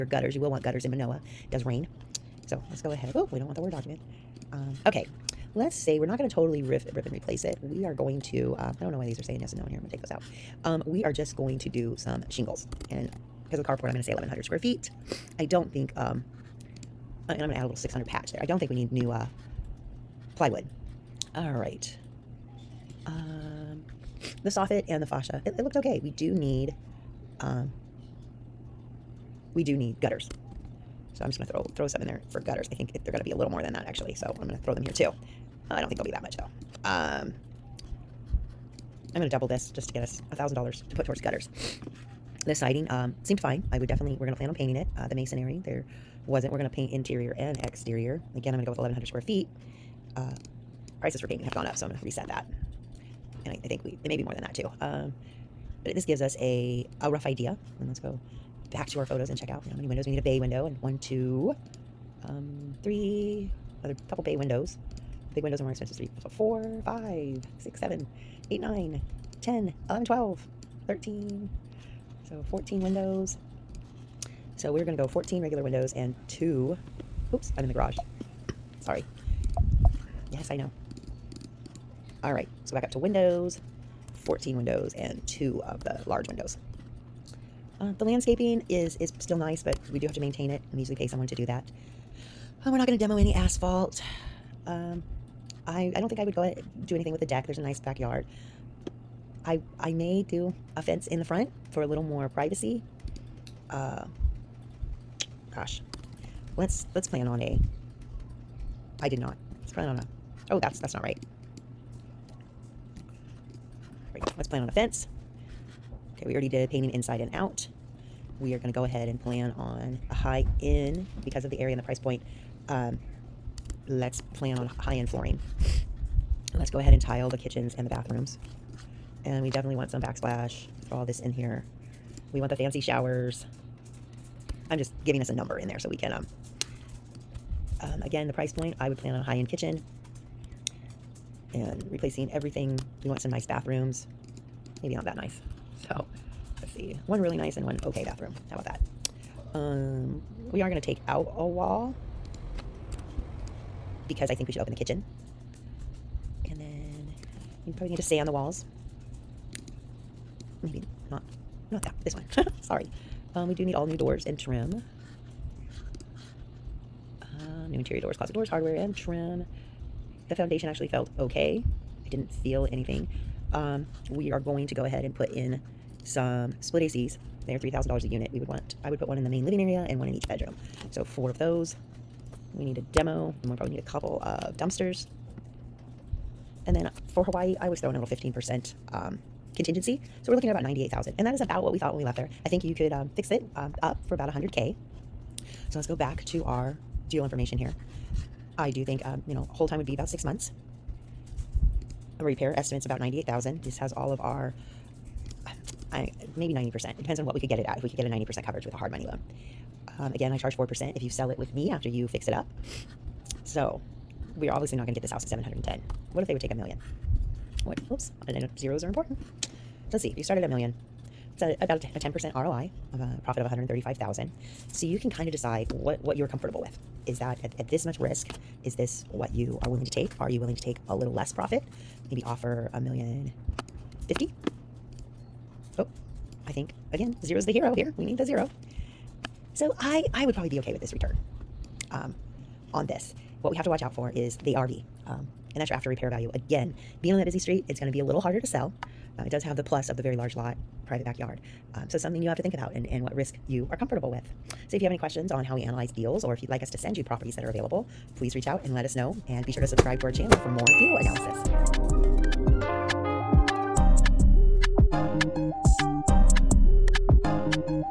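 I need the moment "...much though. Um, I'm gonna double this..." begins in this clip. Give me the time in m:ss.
0:36.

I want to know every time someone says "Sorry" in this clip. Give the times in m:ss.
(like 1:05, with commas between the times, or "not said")
1:18, 2:42.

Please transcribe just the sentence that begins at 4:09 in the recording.
Uh, it does have the plus of the very large lot, private backyard.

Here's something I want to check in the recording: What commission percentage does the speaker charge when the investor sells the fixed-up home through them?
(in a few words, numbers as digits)
4%.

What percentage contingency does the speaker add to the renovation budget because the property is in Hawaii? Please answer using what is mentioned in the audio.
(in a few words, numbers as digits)
15%.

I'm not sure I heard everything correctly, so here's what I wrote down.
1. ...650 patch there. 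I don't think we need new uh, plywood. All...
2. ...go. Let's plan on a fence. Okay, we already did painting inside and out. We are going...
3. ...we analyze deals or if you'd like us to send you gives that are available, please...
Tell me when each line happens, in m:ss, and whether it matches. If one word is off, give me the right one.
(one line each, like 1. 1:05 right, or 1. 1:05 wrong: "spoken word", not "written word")
1. 0:17 wrong: "600", not "650"
2. 1:54 right
3. 4:15 wrong: "properties", not "gives".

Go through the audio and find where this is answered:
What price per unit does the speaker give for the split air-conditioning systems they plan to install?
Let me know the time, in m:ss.
2:57.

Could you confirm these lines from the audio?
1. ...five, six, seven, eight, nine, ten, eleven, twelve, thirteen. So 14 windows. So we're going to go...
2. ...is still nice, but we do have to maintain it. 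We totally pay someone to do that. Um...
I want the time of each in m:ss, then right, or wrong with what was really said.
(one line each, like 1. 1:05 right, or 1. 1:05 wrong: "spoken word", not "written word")
1. 1:06 right
2. 1:28 wrong: "usually", not "totally".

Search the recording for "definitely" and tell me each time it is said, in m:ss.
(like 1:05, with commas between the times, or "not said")
0:43, 2:09.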